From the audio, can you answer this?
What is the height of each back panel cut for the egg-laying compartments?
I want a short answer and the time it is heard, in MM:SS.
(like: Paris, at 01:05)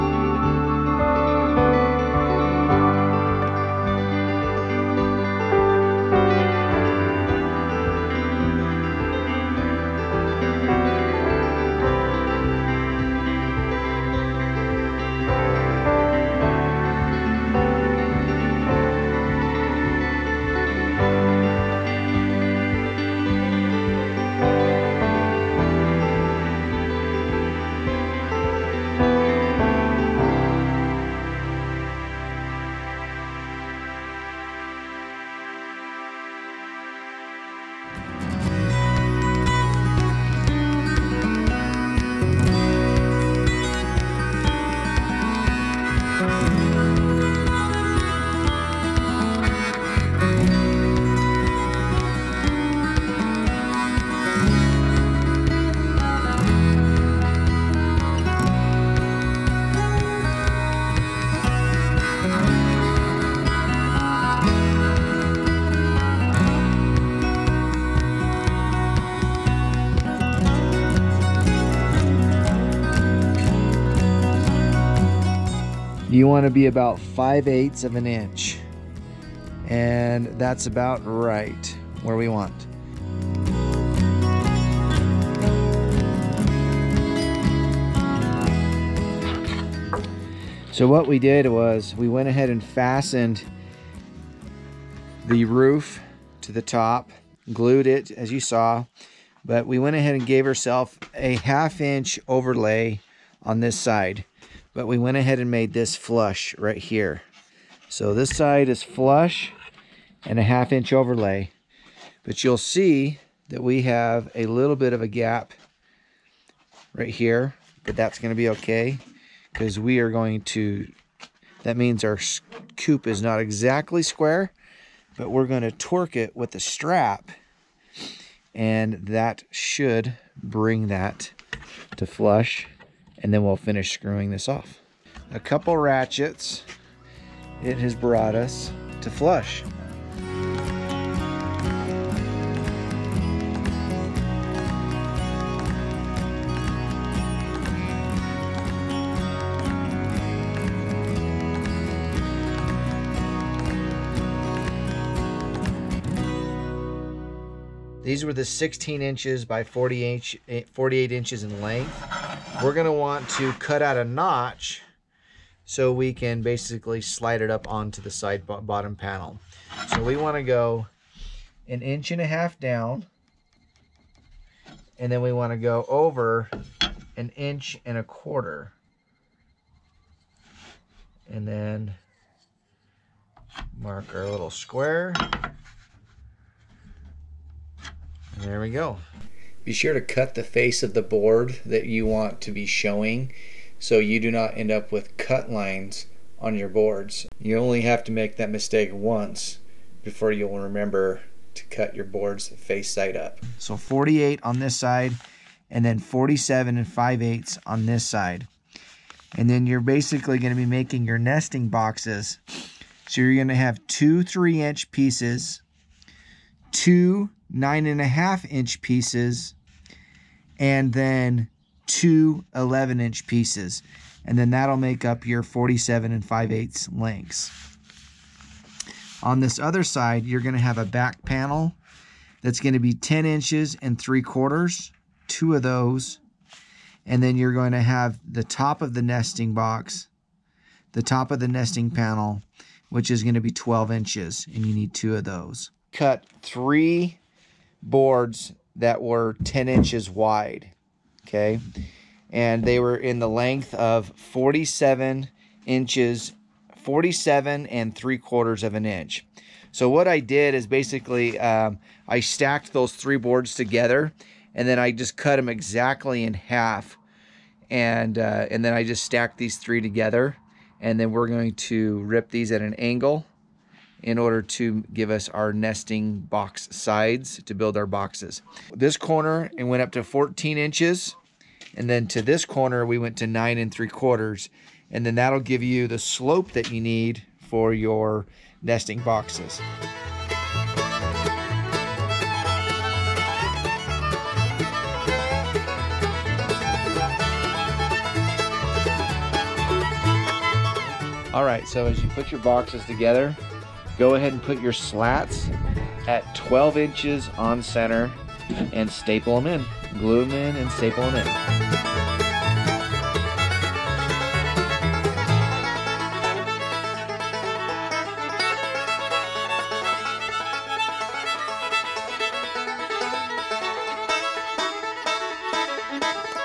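10 3/4 inches, at 03:52.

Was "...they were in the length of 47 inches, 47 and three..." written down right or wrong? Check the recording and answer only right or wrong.
right.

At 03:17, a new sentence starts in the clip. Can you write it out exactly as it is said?
You only have to make that mistake once before you'll remember to cut your boards face side up.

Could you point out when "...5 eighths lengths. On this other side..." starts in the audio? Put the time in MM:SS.
03:46.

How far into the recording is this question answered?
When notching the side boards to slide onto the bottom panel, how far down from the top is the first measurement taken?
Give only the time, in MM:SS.
02:51.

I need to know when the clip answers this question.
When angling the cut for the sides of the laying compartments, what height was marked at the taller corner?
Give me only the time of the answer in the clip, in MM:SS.
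04:40.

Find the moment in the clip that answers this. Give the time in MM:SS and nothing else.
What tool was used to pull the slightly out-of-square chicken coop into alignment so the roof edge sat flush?
02:06.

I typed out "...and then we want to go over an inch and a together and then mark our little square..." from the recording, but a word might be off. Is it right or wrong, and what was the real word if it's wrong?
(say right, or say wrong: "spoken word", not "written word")
wrong: "quarter", not "together".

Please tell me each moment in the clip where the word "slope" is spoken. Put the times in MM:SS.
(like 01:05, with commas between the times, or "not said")
04:45.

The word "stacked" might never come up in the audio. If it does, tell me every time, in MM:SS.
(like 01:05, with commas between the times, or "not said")
04:22, 04:29.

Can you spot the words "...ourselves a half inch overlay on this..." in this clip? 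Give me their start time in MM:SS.
01:40.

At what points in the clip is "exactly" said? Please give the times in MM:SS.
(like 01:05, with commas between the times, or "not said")
02:03, 04:25.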